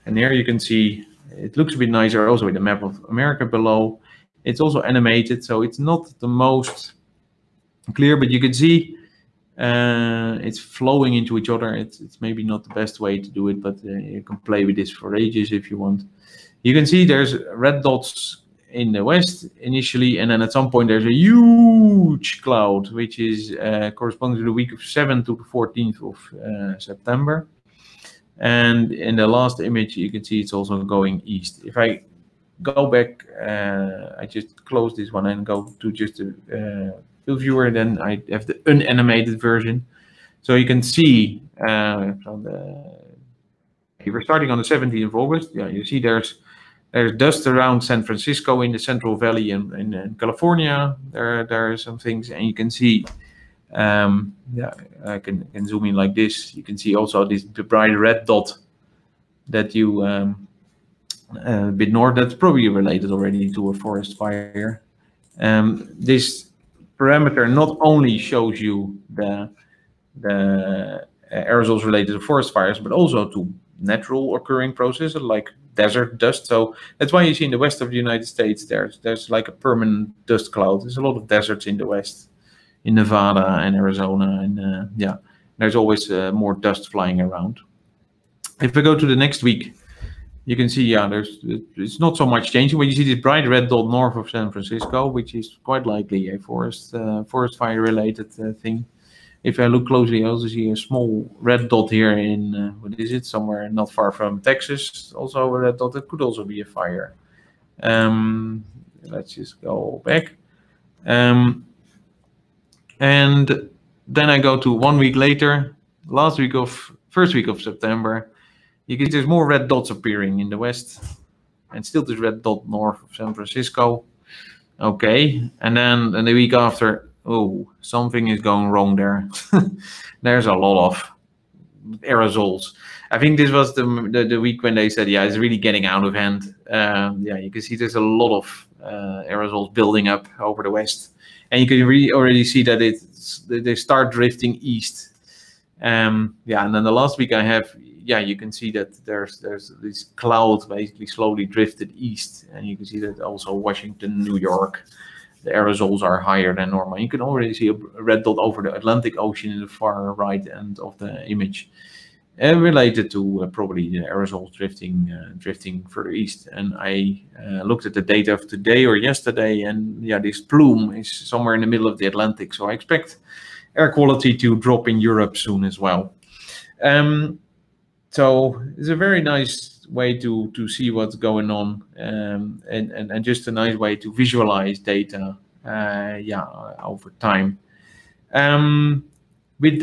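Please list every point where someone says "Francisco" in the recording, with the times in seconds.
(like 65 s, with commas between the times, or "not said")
48 s, 94 s, 123 s.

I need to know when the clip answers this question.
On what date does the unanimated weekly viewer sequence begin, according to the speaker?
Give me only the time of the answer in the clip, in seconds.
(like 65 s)
44 s.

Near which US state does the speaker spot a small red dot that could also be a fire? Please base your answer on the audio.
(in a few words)
Texas.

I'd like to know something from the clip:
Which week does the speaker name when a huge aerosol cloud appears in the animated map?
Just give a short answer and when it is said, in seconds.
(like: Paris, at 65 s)
7th to the 14th of September, at 24 s.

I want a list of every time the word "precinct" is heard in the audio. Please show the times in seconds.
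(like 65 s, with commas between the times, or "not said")
not said.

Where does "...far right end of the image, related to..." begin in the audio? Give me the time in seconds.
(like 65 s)
159 s.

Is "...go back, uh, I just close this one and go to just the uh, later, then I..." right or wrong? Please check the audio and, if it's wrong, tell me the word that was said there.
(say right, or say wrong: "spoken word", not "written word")
wrong: "viewer", not "later".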